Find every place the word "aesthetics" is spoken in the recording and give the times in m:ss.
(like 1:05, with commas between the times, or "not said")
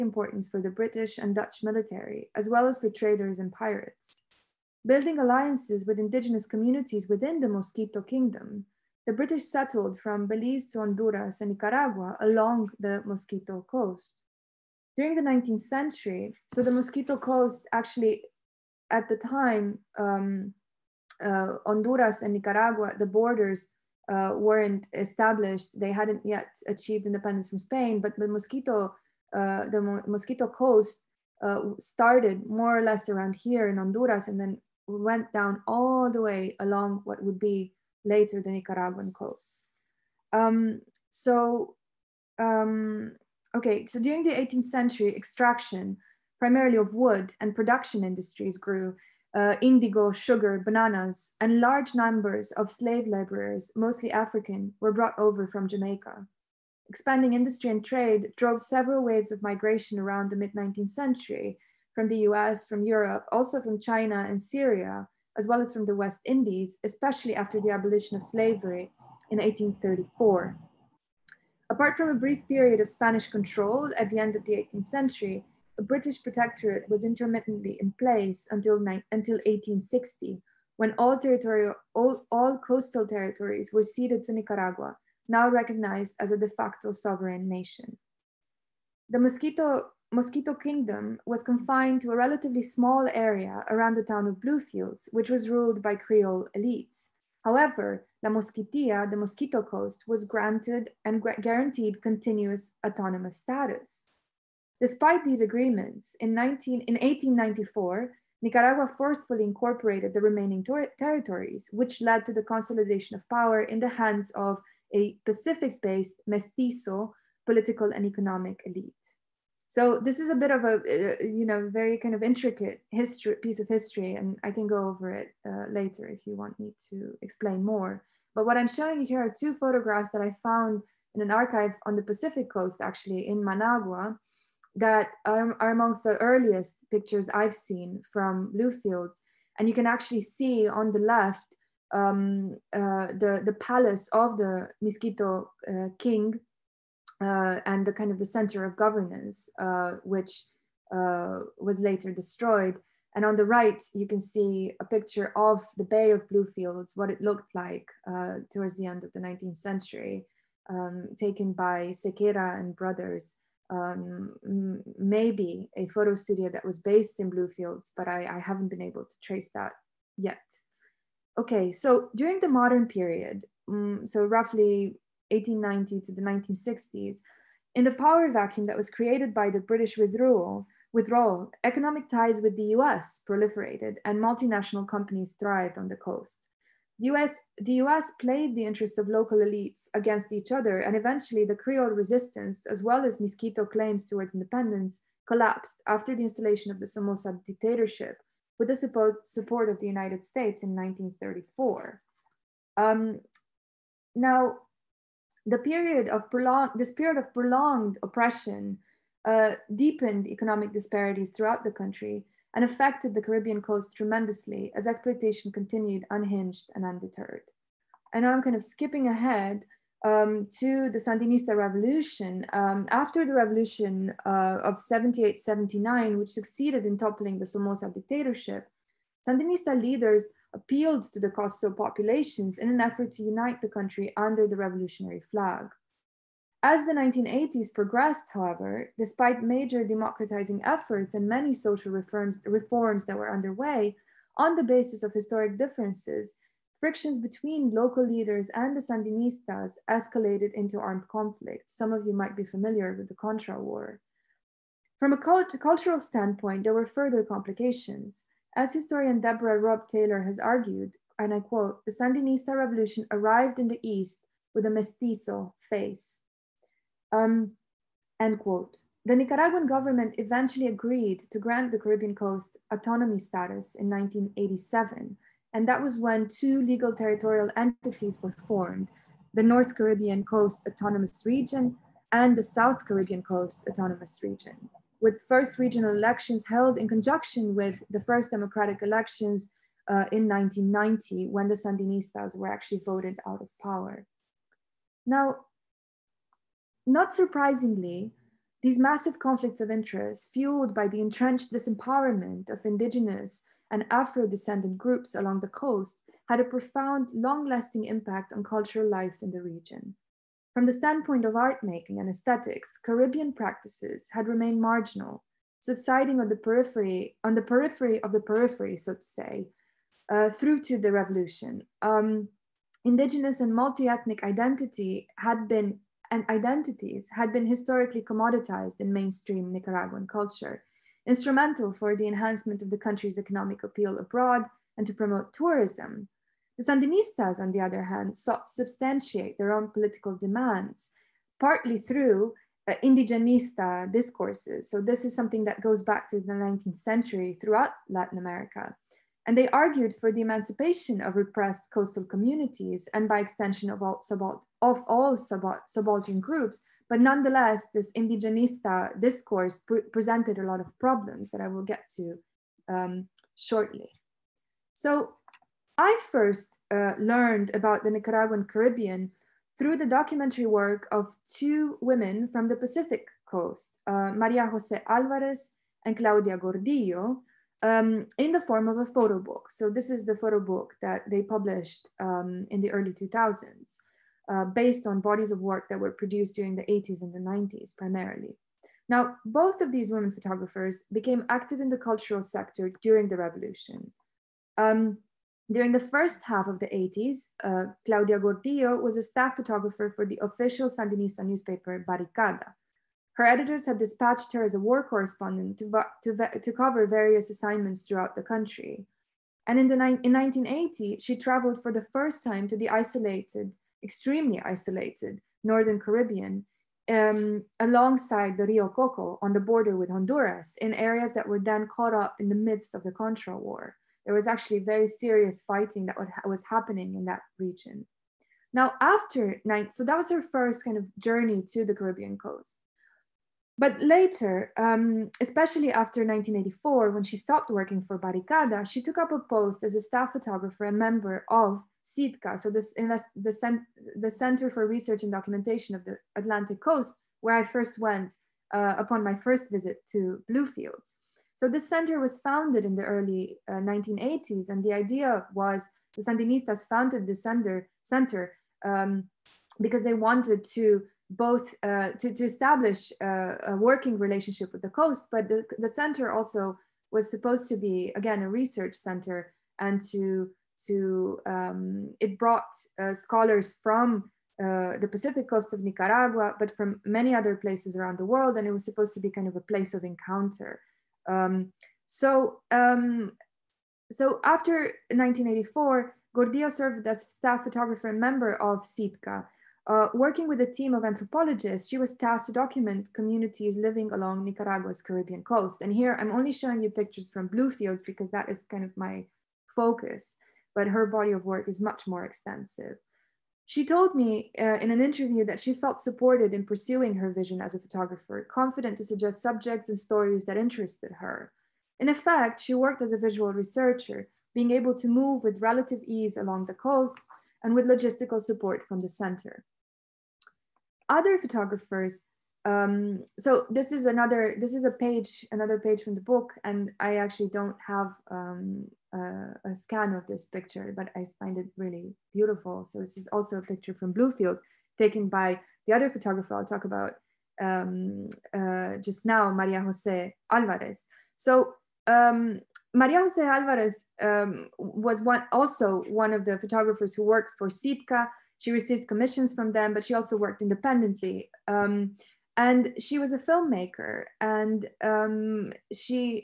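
5:12.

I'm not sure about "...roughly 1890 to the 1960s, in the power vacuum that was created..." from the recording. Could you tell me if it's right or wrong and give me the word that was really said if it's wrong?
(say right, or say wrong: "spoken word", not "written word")
right.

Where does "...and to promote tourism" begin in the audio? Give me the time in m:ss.
5:34.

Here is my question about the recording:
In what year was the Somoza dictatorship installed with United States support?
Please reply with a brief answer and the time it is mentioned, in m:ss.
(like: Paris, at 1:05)
1934, at 3:20.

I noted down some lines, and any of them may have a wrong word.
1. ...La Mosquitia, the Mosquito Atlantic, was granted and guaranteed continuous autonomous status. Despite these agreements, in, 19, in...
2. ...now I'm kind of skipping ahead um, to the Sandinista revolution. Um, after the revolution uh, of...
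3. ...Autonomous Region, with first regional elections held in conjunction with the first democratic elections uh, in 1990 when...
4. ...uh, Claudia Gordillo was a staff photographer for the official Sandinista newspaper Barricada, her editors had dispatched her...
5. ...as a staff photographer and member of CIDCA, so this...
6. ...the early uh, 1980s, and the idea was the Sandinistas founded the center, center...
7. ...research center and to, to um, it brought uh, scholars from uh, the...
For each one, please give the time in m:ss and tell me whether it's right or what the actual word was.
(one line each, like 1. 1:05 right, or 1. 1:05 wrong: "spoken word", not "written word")
1. 1:38 wrong: "Coast", not "Atlantic"
2. 3:38 right
3. 4:43 right
4. 6:37 right
5. 7:19 right
6. 7:32 right
7. 7:48 right.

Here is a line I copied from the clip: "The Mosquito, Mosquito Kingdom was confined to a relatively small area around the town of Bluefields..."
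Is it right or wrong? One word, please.
right.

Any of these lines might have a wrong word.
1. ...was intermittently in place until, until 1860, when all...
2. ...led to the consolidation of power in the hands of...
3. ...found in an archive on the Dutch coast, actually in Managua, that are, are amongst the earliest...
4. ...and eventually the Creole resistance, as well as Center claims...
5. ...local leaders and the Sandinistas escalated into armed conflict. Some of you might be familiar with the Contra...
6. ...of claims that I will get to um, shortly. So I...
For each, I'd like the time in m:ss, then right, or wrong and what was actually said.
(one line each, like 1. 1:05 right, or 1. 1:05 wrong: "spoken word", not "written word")
1. 1:16 right
2. 1:52 right
3. 2:10 wrong: "Pacific", not "Dutch"
4. 3:10 wrong: "Mosquito", not "Center"
5. 4:07 right
6. 6:00 wrong: "problems", not "claims".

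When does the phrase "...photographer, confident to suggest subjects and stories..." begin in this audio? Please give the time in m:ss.
8:27.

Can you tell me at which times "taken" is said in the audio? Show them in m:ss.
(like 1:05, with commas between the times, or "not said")
2:41, 8:54.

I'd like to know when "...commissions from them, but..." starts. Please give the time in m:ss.
9:08.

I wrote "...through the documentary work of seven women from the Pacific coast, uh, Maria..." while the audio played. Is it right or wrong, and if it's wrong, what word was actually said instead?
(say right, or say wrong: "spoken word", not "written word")
wrong: "two", not "seven".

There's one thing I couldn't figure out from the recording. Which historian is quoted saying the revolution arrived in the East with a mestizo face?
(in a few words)
Deborah Robb Taylor.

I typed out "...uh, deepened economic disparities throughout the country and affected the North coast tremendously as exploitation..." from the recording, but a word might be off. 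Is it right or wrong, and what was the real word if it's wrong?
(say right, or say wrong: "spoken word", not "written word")
wrong: "Caribbean", not "North".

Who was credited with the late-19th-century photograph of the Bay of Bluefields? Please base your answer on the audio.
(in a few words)
Sequeira and brothers.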